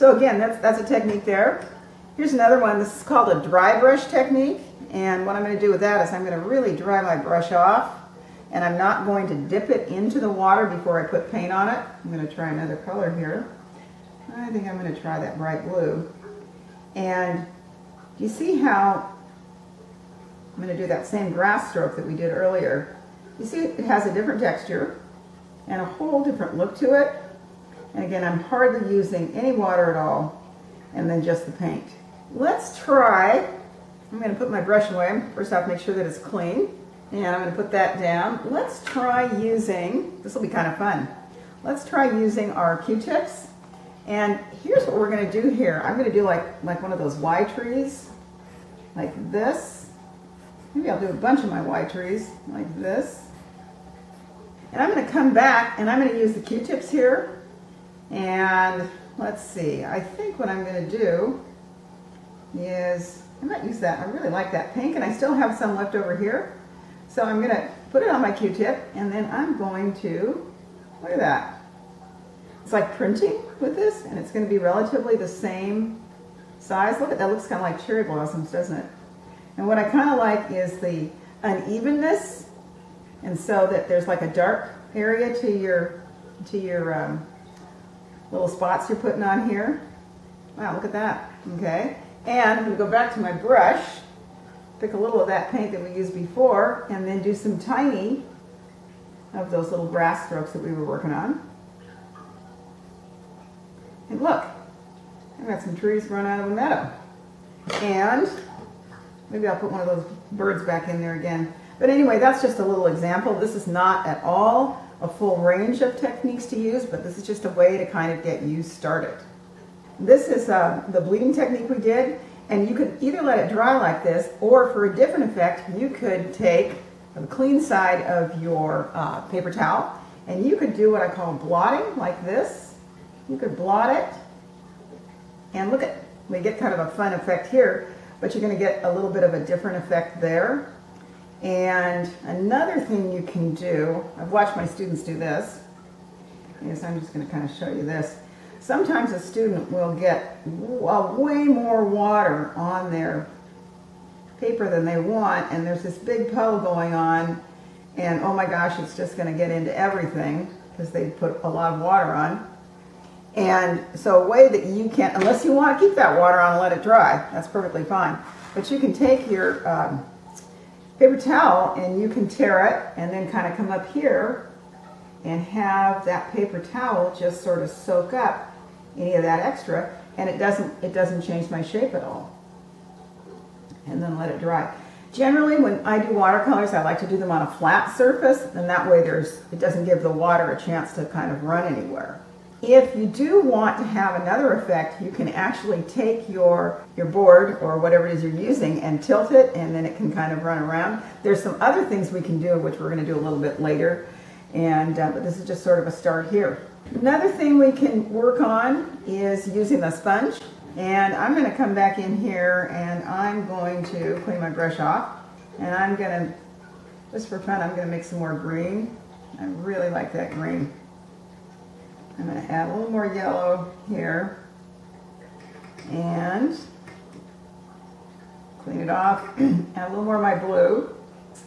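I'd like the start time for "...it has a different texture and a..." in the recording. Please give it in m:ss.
0:23.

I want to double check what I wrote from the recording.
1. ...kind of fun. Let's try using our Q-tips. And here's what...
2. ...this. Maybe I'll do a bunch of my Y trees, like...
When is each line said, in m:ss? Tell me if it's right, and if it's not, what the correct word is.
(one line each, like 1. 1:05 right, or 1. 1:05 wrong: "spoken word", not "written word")
1. 0:40 right
2. 0:49 right.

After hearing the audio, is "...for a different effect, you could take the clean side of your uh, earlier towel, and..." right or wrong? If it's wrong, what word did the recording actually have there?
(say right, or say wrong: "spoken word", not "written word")
wrong: "paper", not "earlier".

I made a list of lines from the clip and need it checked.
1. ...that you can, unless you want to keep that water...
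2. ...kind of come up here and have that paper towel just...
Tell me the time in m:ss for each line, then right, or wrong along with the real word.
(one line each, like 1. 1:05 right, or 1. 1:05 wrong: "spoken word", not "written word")
1. 2:44 right
2. 2:53 right.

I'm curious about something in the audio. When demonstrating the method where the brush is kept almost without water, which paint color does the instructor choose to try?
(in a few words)
bright blue.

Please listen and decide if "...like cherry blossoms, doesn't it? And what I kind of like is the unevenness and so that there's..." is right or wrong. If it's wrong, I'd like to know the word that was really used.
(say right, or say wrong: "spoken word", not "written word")
right.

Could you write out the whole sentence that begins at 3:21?
There's some other things we can do, which we're gonna do a little bit later.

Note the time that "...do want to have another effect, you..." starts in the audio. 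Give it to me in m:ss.
3:13.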